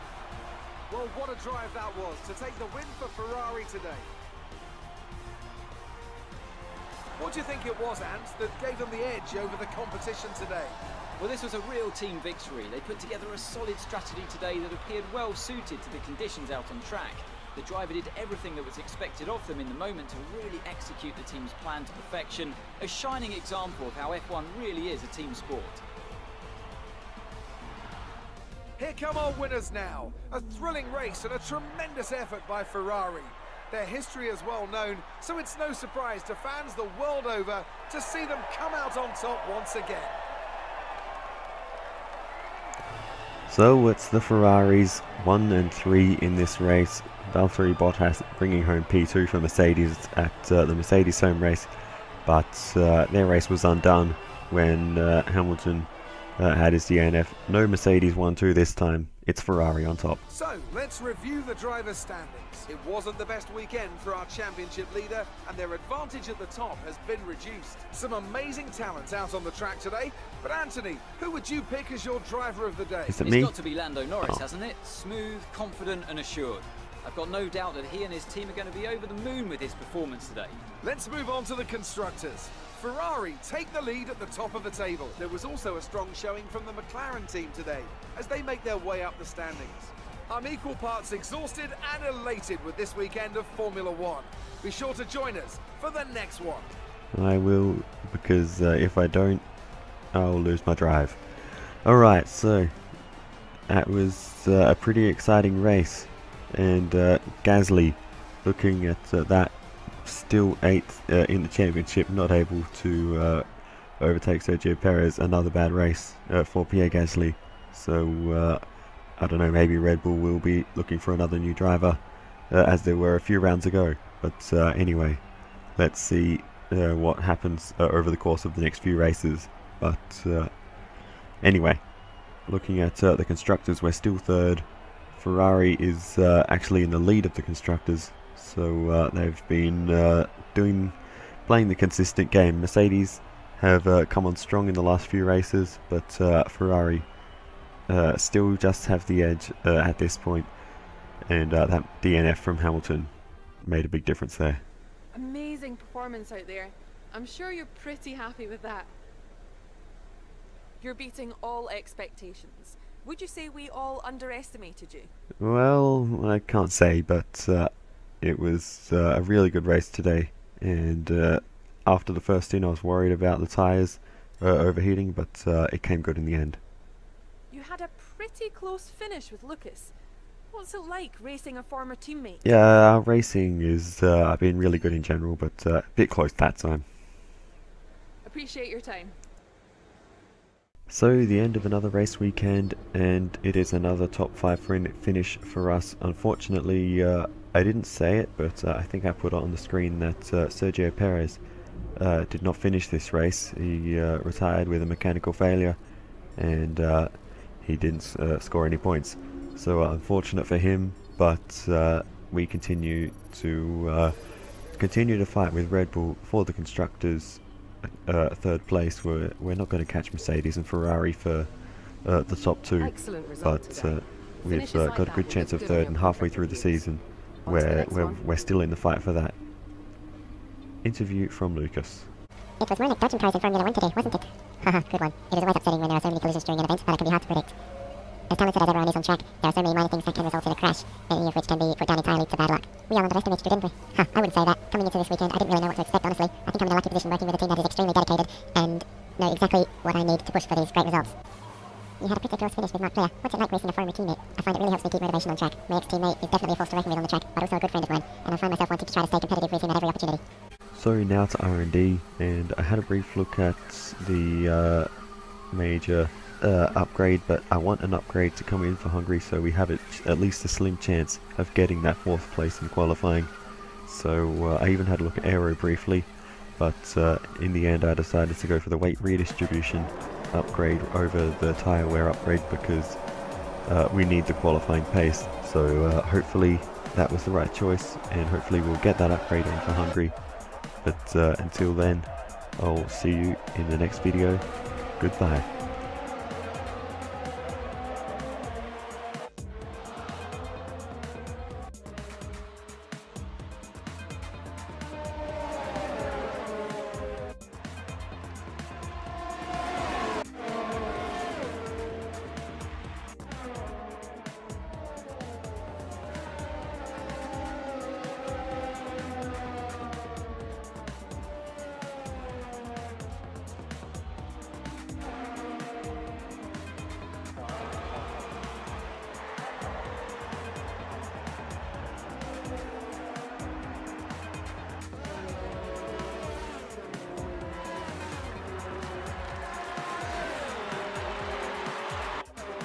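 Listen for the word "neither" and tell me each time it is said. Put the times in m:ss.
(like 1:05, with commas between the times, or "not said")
not said.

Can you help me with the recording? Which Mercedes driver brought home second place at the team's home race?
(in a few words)
Valtteri Bottas.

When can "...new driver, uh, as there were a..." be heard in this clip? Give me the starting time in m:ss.
2:01.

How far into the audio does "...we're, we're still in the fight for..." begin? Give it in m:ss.
3:47.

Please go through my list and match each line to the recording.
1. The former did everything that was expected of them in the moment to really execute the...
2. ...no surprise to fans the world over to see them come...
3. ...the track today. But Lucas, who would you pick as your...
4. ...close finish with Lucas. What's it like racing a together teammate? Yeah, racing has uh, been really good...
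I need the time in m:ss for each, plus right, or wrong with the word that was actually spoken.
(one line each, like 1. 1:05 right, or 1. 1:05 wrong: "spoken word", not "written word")
1. 0:17 wrong: "driver", not "former"
2. 0:35 right
3. 1:09 wrong: "Anthony", not "Lucas"
4. 2:58 wrong: "former", not "together".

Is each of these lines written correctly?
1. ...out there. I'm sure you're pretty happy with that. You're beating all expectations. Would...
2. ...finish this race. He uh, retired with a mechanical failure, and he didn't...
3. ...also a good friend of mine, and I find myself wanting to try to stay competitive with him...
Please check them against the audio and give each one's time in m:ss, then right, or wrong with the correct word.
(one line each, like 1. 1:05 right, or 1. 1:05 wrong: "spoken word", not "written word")
1. 2:36 right
2. 3:22 right
3. 4:17 right.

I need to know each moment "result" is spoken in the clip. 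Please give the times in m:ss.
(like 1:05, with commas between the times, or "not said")
4:00, 4:10.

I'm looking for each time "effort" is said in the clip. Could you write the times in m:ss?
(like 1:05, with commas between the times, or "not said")
0:32.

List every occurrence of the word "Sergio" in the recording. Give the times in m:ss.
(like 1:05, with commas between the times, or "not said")
1:54, 3:20.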